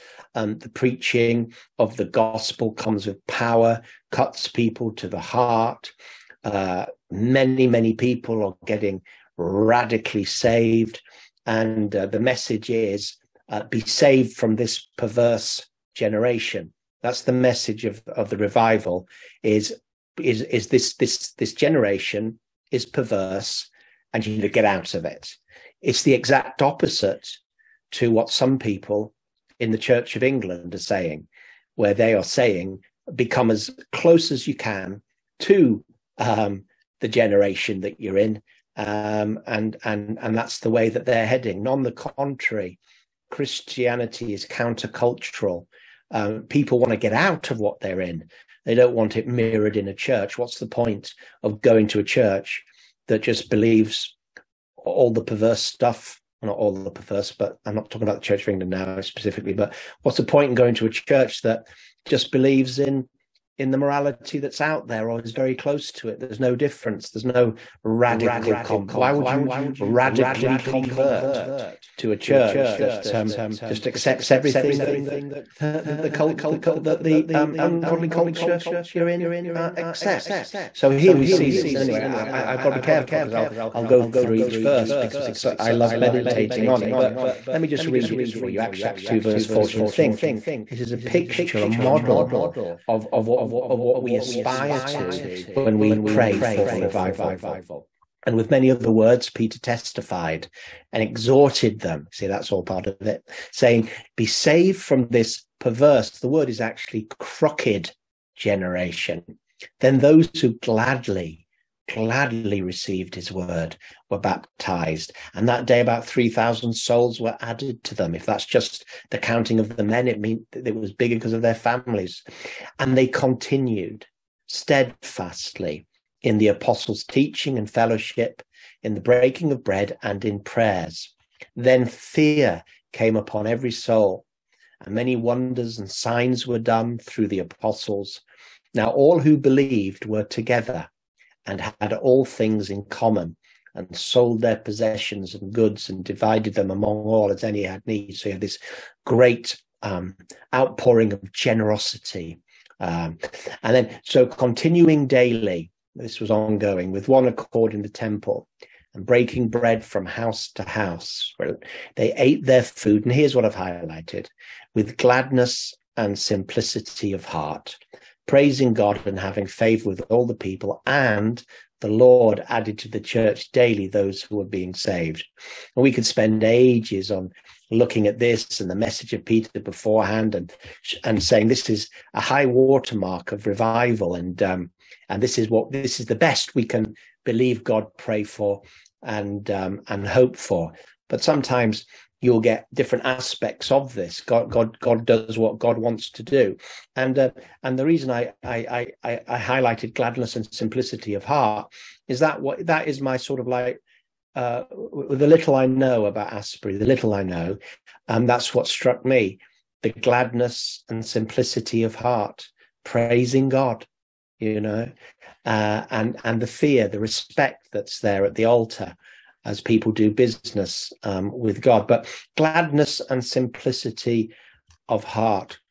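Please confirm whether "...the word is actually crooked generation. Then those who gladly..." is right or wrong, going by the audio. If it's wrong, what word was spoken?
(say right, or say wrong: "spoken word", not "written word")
right.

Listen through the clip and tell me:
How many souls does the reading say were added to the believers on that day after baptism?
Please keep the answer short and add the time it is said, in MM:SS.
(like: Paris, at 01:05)
3,000, at 01:56.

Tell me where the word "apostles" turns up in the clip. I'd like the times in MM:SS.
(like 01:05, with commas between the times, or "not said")
02:06, 02:17.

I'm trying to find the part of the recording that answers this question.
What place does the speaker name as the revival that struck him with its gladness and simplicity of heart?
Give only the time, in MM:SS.
03:26.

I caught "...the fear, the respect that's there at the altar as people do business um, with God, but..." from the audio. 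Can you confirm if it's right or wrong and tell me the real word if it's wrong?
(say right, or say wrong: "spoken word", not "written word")
right.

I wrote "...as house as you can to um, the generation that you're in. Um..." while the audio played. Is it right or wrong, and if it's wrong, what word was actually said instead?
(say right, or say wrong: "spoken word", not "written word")
wrong: "close", not "house".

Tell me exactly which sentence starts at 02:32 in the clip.
Um, and then, so continuing daily, this was ongoing with one accord in the temple and breaking bread from house to house.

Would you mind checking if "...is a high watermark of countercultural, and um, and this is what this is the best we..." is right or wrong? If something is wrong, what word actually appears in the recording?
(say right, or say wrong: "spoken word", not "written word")
wrong: "revival", not "countercultural".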